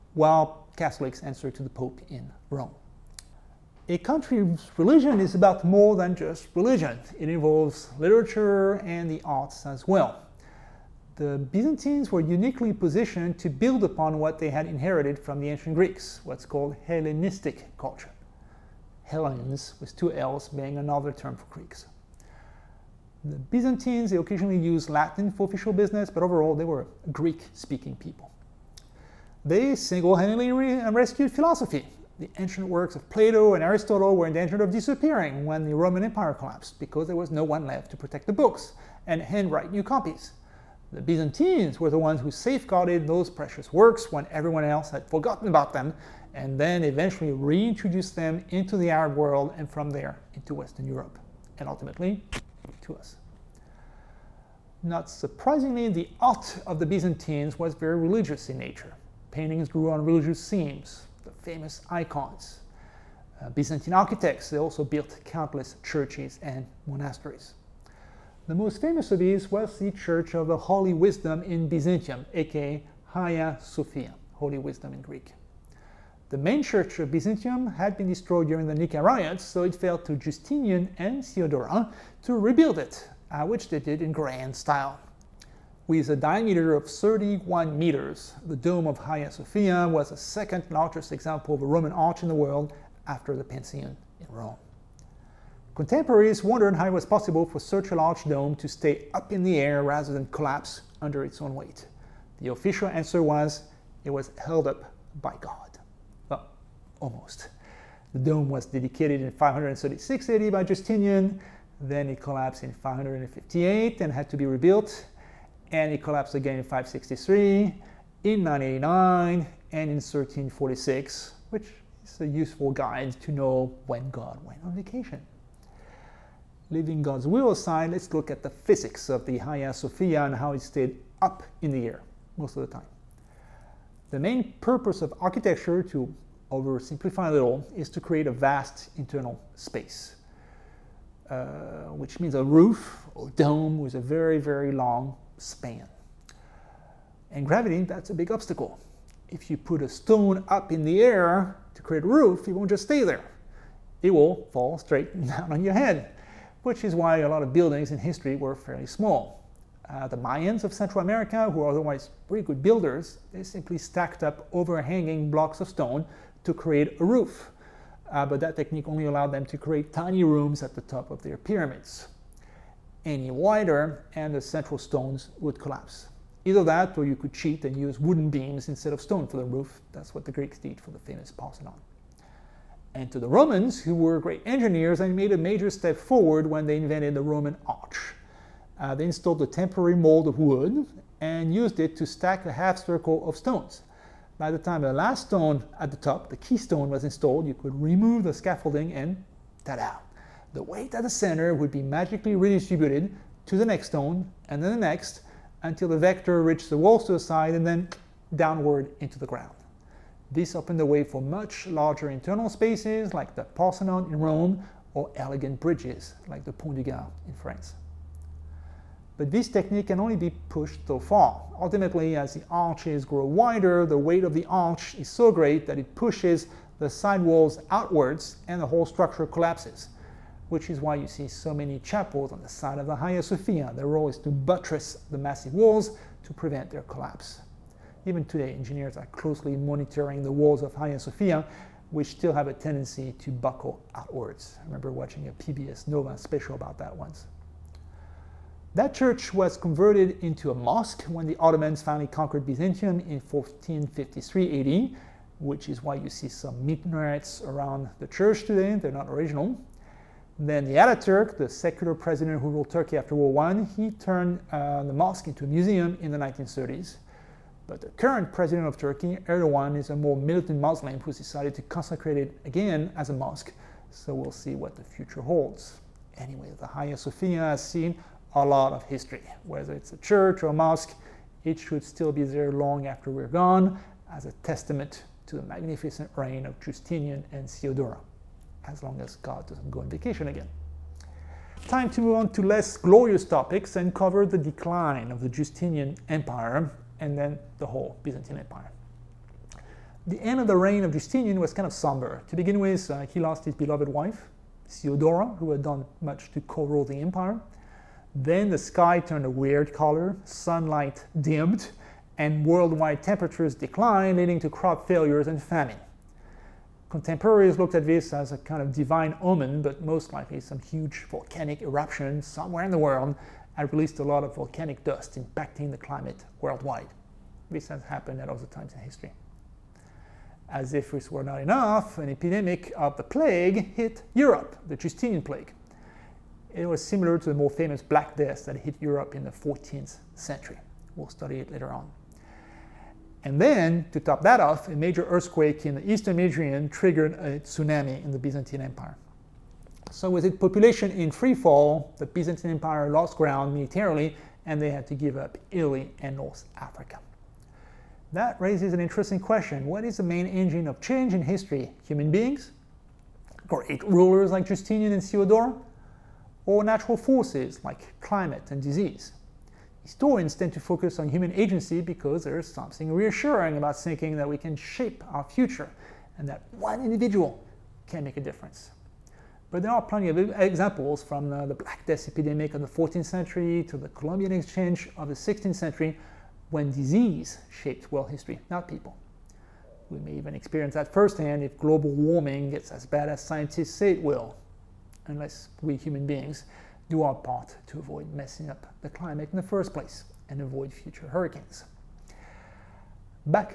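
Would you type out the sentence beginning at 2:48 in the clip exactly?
Uh, but that technique only allowed them to create tiny rooms at the top of their pyramids.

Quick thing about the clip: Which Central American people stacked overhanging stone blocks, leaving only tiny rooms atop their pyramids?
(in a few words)
Mayans.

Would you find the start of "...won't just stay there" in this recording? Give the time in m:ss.
2:32.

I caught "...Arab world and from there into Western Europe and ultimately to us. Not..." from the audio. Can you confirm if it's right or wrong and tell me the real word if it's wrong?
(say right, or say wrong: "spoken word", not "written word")
right.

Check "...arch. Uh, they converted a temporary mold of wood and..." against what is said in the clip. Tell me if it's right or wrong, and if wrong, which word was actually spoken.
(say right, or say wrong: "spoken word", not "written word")
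wrong: "installed", not "converted".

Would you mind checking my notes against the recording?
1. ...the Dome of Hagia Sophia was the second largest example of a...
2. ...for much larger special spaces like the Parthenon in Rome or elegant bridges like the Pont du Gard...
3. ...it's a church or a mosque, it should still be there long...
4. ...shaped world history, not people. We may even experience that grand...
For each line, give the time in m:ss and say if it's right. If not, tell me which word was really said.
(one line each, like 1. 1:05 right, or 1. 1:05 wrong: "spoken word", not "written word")
1. 1:28 right
2. 3:31 wrong: "internal", not "special"
3. 4:39 right
4. 6:27 wrong: "firsthand", not "grand".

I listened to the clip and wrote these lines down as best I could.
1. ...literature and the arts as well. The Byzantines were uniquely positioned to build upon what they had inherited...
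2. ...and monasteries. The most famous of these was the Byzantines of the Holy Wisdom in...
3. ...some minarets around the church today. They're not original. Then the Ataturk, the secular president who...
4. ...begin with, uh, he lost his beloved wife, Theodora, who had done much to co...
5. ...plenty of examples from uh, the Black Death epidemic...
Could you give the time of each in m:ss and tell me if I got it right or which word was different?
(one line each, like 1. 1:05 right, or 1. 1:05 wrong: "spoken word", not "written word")
1. 0:07 right
2. 1:06 wrong: "Church", not "Byzantines"
3. 4:16 right
4. 5:02 right
5. 6:19 right.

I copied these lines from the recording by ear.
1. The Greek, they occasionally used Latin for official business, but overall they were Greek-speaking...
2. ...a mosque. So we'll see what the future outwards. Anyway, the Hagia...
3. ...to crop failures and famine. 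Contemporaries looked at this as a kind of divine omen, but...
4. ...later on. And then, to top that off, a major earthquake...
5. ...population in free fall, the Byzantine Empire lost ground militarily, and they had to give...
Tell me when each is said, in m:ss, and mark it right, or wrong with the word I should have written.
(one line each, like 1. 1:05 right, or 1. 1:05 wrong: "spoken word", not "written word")
1. 0:23 wrong: "Byzantines", not "Greek"
2. 4:33 wrong: "holds", not "outwards"
3. 5:14 right
4. 5:41 right
5. 5:50 right.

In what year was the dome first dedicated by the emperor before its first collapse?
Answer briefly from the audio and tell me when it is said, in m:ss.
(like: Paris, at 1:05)
536 AD, at 1:49.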